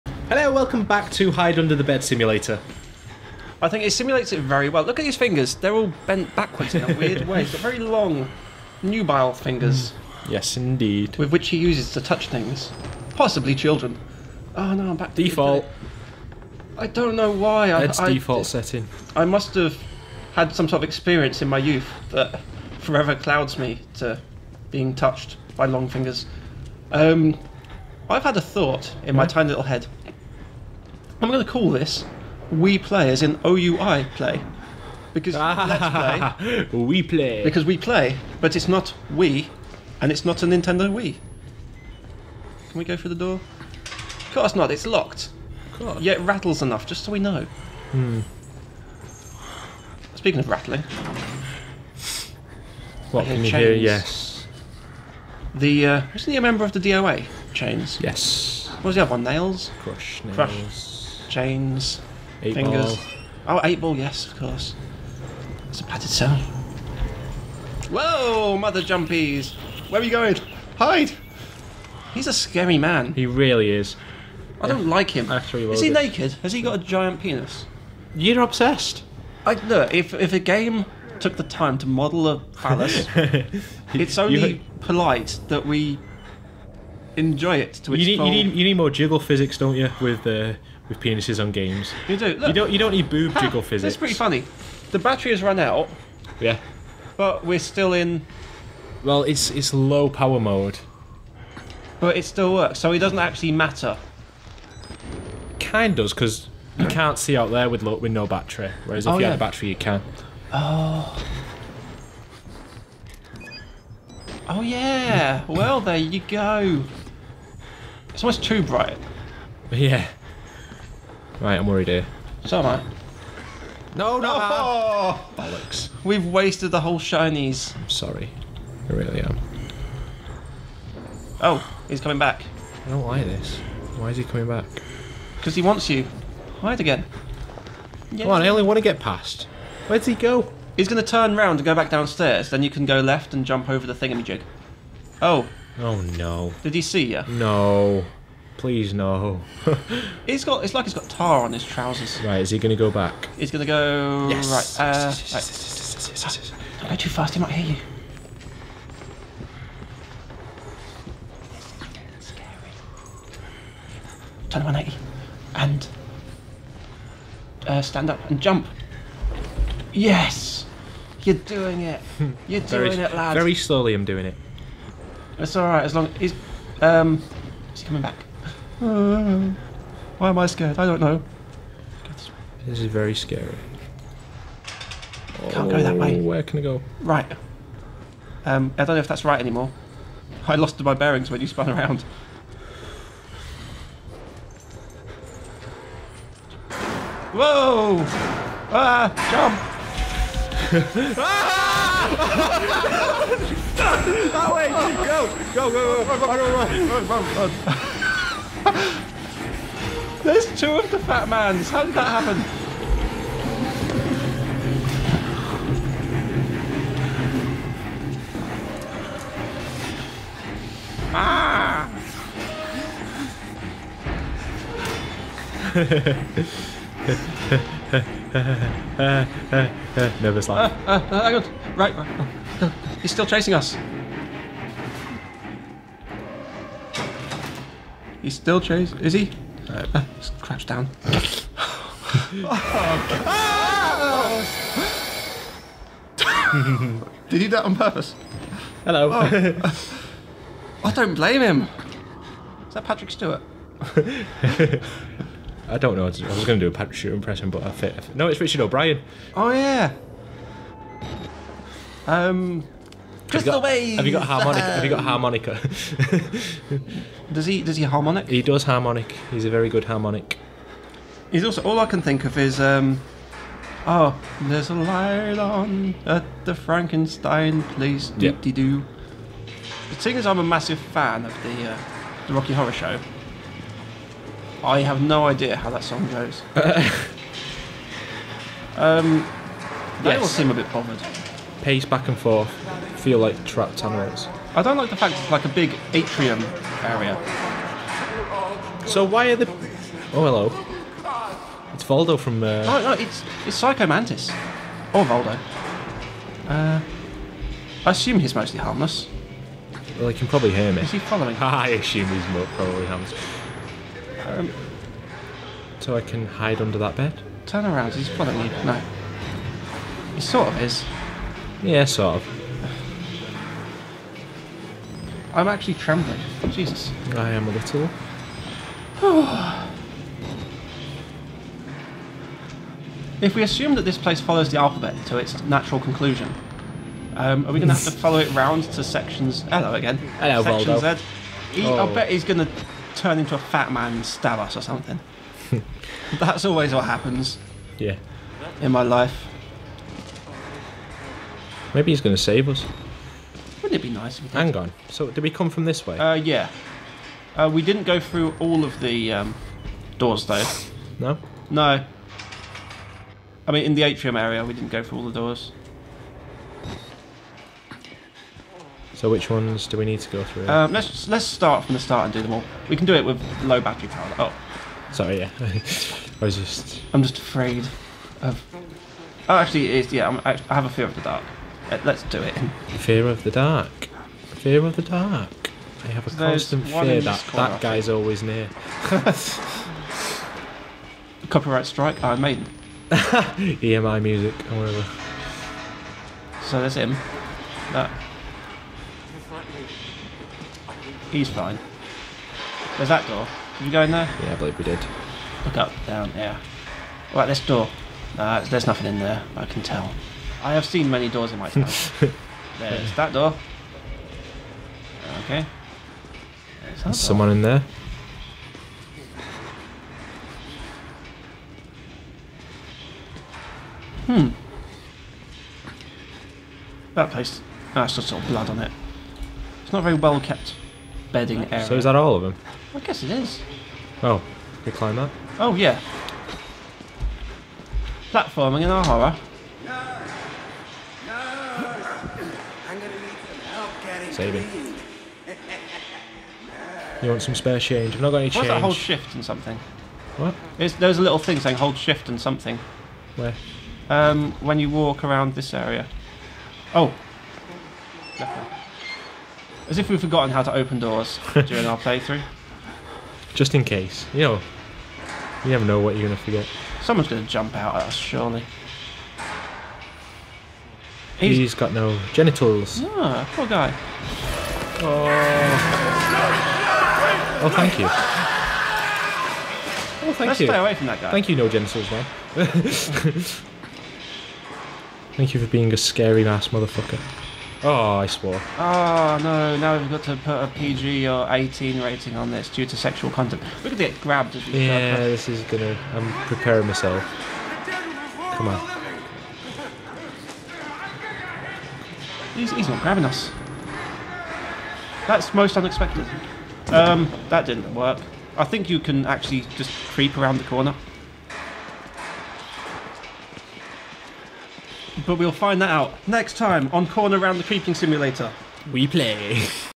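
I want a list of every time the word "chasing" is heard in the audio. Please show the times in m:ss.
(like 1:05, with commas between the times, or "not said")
3:53, 3:58.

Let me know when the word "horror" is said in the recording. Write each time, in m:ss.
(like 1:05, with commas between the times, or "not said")
4:42, 7:18.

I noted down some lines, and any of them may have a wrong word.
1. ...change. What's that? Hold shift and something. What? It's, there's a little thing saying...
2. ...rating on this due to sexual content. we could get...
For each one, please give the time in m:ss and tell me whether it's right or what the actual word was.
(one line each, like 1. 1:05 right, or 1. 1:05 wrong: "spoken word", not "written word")
1. 7:28 right
2. 8:11 right.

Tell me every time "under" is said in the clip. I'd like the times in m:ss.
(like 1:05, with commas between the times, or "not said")
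0:01, 5:16.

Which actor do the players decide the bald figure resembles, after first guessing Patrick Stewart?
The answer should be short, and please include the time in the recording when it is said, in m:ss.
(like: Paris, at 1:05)
Richard O'Brien, at 4:18.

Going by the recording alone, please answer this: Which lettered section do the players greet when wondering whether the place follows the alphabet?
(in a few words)
Section Z.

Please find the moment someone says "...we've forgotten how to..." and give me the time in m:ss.
7:39.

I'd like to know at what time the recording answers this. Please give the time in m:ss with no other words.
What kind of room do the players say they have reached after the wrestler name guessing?
1:05.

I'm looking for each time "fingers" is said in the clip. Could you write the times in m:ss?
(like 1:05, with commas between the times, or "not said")
0:05, 0:09, 0:25, 1:02.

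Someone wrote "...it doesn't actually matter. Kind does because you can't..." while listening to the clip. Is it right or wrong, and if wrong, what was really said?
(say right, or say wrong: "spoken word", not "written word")
right.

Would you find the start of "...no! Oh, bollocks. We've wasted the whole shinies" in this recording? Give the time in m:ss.
2:04.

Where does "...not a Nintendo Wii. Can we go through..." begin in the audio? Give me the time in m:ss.
0:40.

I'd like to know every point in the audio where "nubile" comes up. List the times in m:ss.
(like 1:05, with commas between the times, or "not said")
0:08.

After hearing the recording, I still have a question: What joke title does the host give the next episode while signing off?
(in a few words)
Corner Around the Creeping Simulator.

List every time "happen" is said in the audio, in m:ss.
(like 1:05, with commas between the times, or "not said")
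3:32, 5:46.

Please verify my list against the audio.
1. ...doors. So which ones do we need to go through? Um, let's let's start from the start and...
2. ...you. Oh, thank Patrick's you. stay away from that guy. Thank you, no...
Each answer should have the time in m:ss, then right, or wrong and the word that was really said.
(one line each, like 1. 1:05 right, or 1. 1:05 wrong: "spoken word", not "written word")
1. 6:05 right
2. 7:57 wrong: "Let", not "Patrick".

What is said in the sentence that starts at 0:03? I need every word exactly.
I think it simulates it very well.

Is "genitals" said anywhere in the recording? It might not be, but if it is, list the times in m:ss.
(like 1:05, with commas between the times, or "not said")
7:52, 8:01.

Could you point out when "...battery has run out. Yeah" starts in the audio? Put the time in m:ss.
1:34.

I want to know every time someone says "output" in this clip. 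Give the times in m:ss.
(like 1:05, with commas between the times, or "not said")
not said.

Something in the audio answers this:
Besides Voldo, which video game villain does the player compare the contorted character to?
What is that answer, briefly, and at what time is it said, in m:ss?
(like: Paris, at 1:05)
Psycho Mantis, at 5:03.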